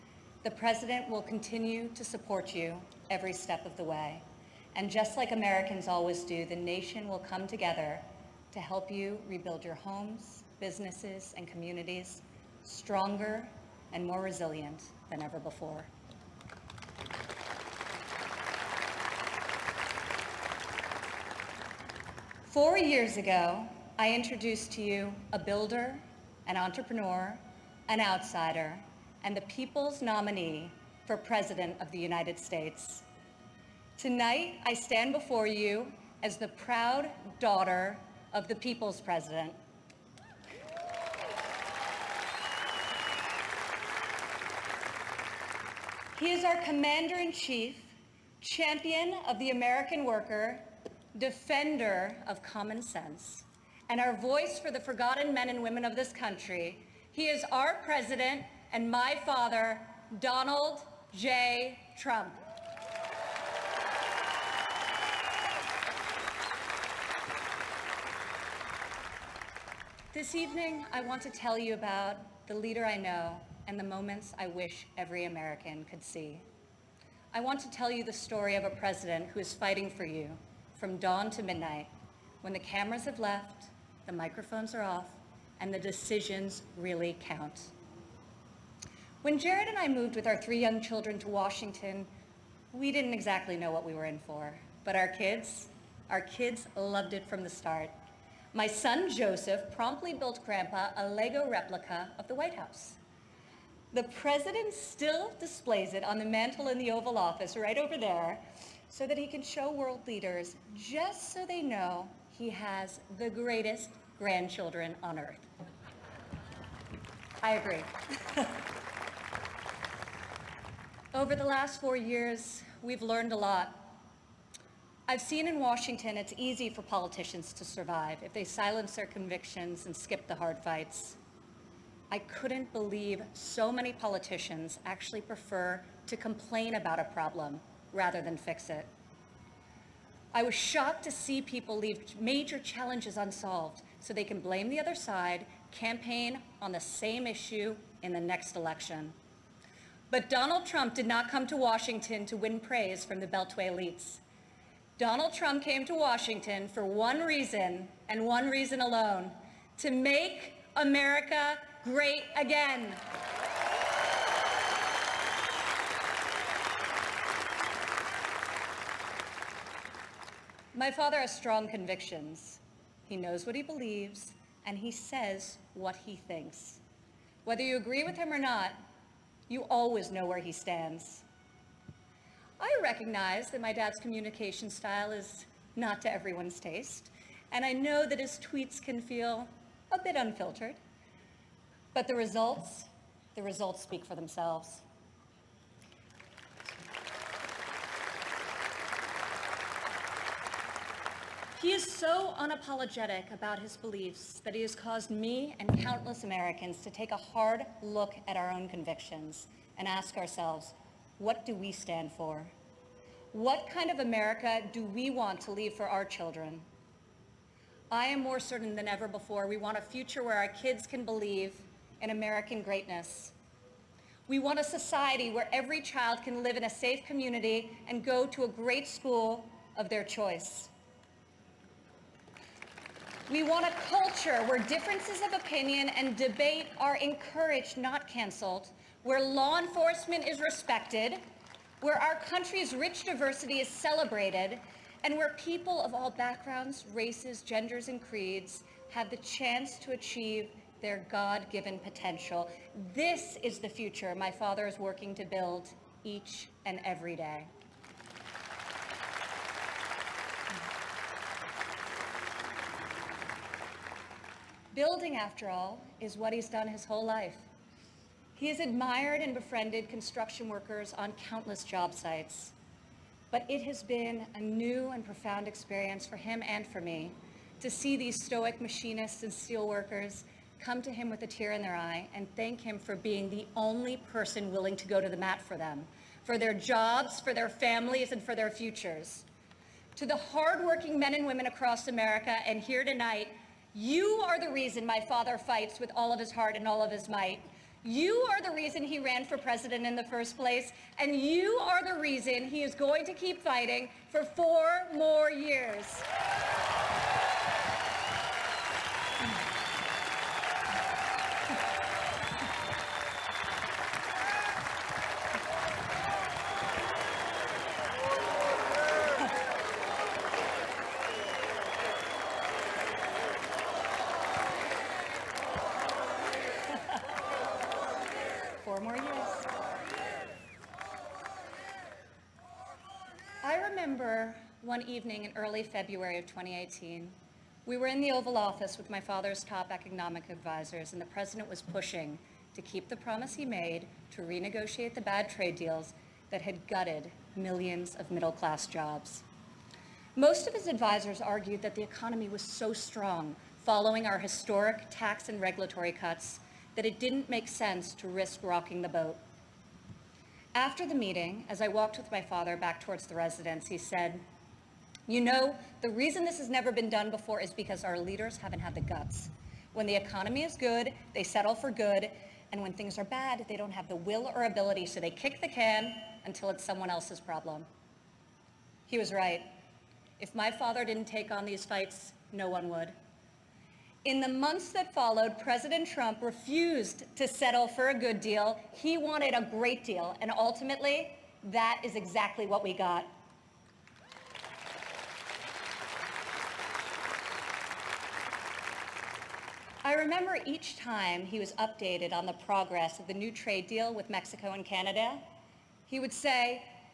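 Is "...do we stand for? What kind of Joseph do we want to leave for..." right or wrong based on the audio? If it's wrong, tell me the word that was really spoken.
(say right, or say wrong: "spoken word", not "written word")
wrong: "America", not "Joseph".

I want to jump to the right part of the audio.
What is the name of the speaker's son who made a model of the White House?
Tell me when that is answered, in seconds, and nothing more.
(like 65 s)
99 s.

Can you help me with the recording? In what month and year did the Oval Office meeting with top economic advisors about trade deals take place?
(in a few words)
February 2018.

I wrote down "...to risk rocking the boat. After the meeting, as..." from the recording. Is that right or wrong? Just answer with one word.
right.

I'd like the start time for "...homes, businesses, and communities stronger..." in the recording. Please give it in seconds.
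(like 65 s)
9 s.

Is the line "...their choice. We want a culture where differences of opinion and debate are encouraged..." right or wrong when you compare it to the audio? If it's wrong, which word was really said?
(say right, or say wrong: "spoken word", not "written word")
right.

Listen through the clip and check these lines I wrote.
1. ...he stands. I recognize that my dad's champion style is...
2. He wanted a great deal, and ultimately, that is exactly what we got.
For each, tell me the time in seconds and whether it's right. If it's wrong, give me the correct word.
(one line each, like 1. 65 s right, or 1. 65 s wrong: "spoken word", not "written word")
1. 180 s wrong: "communication", not "champion"
2. 388 s right.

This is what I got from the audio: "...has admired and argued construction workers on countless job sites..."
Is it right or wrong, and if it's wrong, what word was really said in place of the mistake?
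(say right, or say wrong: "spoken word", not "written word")
wrong: "befriended", not "argued".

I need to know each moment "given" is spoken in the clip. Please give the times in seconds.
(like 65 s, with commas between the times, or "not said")
251 s.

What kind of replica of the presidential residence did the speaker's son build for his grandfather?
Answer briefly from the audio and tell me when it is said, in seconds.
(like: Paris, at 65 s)
Lego replica, at 101 s.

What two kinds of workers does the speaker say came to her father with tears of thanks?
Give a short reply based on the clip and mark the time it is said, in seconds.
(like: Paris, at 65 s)
machinists and steelworkers, at 278 s.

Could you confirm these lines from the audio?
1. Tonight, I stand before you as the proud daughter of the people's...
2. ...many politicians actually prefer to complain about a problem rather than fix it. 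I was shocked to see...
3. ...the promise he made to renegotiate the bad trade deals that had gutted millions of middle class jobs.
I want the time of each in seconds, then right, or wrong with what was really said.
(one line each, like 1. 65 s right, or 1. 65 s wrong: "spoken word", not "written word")
1. 33 s right
2. 133 s right
3. 342 s right.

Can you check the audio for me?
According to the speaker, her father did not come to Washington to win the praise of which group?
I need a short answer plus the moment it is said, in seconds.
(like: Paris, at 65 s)
Beltway elites, at 153 s.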